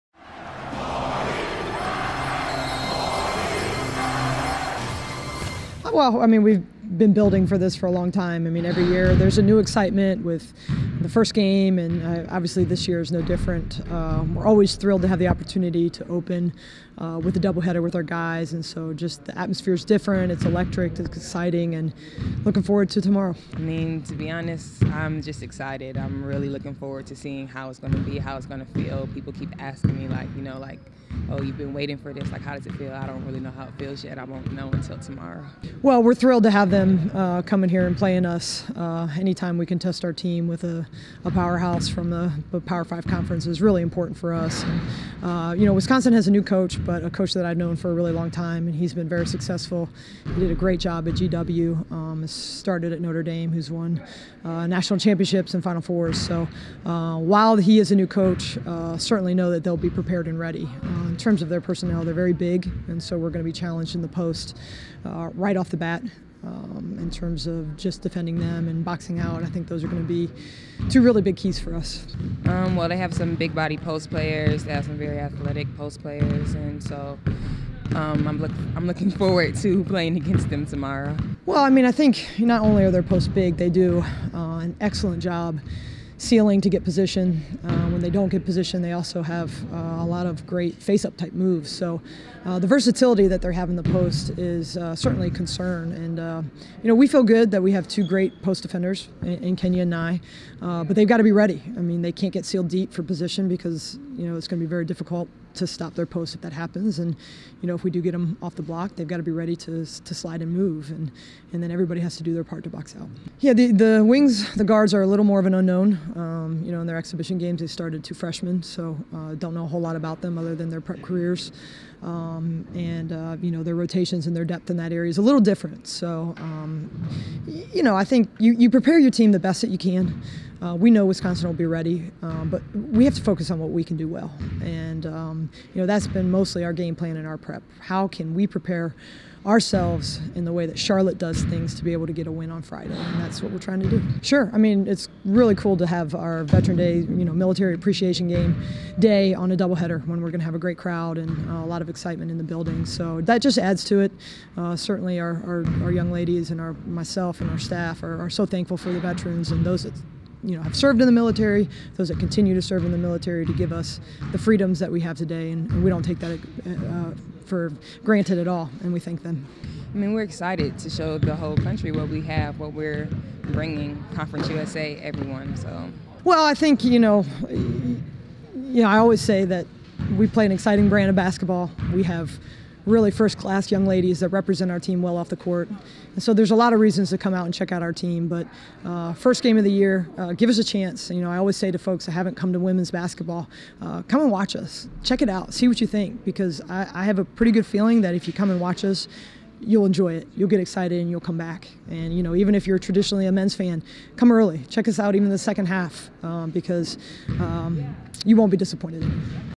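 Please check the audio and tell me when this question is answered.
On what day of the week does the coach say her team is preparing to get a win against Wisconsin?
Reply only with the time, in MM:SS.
02:22.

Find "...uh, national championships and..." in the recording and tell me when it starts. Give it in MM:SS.
00:54.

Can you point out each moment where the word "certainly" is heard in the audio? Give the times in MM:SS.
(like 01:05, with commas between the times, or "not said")
00:58, 01:34, 02:34.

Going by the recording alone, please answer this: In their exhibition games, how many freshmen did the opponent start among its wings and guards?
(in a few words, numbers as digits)
2.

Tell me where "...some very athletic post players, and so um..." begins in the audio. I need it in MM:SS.
01:14.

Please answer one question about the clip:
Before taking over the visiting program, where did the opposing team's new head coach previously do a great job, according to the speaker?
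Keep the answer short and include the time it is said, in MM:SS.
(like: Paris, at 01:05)
GW, at 00:51.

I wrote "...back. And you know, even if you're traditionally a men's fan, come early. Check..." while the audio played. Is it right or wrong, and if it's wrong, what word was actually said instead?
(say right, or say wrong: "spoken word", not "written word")
right.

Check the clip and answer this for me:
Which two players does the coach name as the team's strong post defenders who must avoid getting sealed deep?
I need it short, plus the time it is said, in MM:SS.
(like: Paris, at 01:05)
Kenya and Nye, at 01:39.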